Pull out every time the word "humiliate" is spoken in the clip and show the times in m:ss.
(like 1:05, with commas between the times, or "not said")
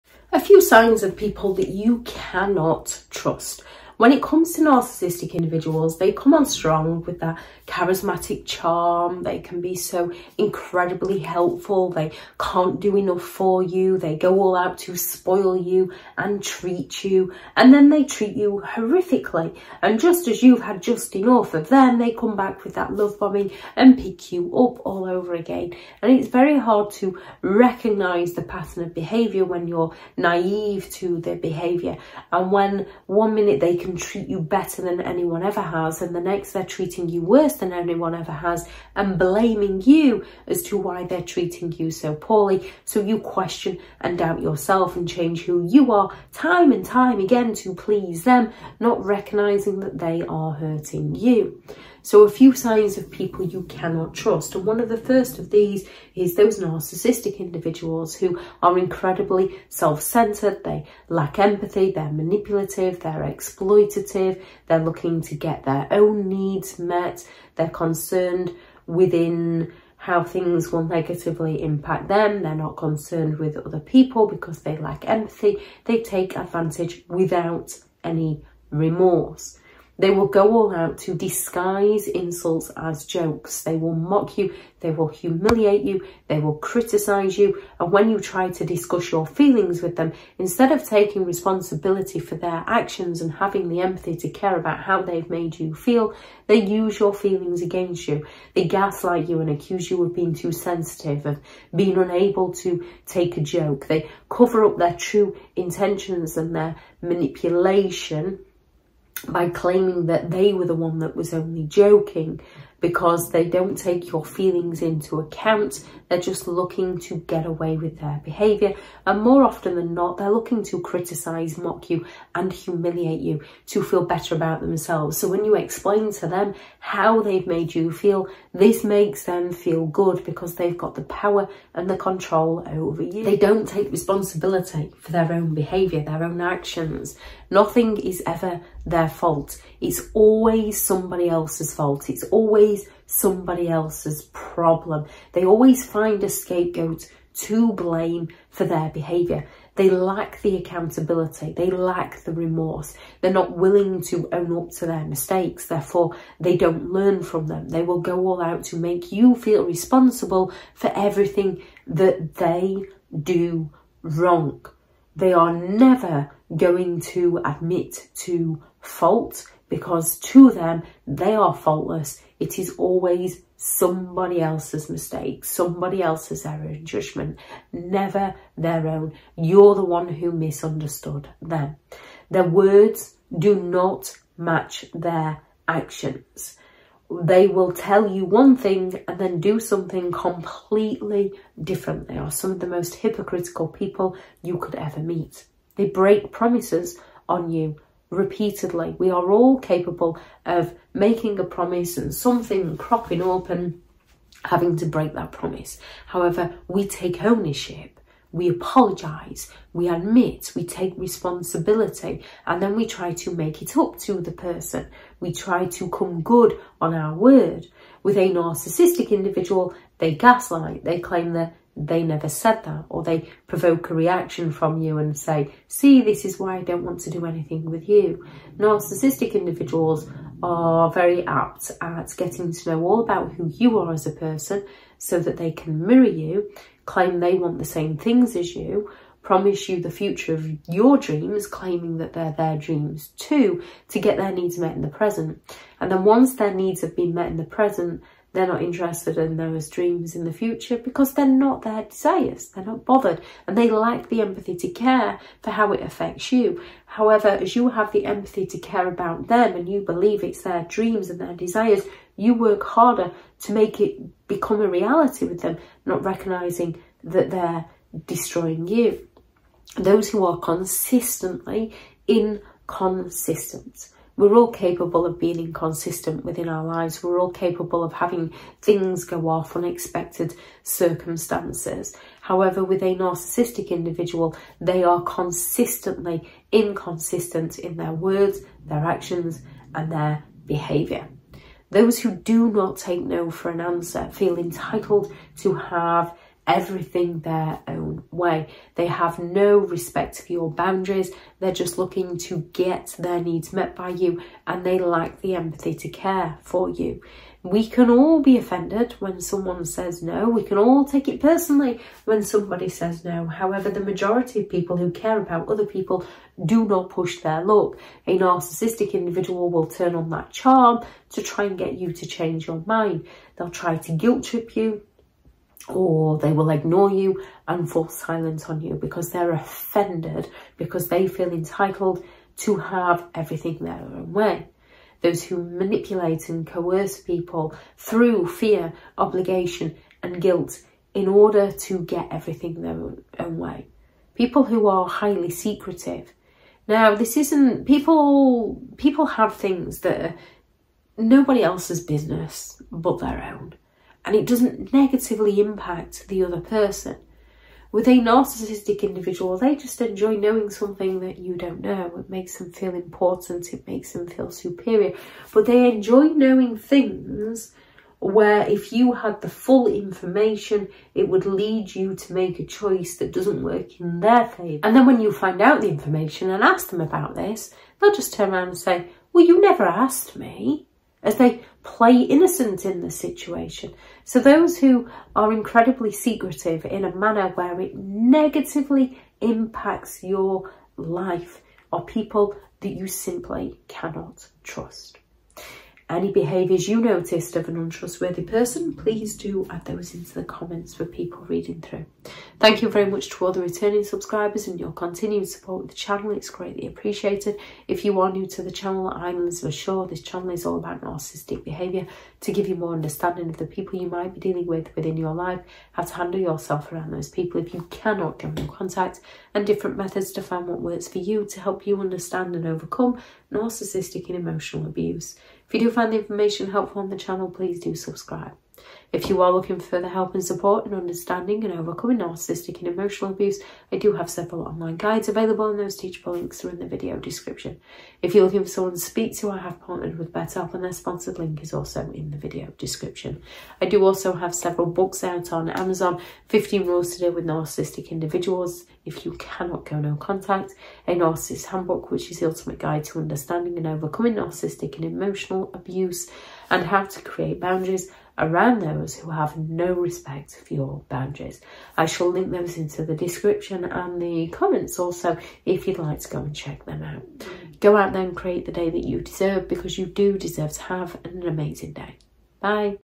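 1:25, 2:02.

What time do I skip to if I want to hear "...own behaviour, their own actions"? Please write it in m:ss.
2:15.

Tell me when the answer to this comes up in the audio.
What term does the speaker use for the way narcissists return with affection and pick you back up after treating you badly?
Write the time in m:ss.
0:22.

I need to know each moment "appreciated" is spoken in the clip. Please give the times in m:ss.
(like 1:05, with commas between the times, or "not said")
6:46.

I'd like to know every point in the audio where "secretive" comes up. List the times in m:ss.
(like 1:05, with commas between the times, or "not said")
5:45, 6:25.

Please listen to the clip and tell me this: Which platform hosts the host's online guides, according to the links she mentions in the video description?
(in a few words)
Teachable.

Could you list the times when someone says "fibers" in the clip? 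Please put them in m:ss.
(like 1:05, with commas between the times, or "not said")
not said.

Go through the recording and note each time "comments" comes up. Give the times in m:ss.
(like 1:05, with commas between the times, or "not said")
6:40, 7:44.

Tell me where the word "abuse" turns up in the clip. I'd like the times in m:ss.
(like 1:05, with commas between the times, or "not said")
7:04, 7:13, 7:35.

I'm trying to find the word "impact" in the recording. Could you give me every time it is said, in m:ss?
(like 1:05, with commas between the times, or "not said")
1:11, 5:55, 6:29.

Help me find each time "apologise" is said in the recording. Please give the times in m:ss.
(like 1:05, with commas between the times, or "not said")
3:28.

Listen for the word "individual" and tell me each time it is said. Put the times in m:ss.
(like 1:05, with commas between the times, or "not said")
0:05, 0:57, 3:39, 3:49, 4:43, 5:18, 5:58, 7:27.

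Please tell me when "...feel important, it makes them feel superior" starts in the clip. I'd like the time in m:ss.
6:02.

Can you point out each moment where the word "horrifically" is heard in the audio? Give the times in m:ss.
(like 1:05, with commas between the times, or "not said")
0:18.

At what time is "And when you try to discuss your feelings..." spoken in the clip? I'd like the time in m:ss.
1:27.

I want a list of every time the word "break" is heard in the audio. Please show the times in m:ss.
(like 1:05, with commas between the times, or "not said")
3:15, 3:24.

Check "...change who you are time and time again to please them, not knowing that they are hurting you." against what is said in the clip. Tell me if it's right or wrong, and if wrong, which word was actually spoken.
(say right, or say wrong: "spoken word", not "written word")
wrong: "recognizing", not "knowing".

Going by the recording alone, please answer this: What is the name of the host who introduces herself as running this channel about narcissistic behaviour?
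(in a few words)
Elizabeth Shaw.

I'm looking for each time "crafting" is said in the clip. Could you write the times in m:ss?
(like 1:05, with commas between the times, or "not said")
not said.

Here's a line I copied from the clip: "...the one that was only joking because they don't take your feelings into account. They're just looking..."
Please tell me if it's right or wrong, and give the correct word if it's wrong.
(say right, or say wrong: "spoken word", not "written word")
right.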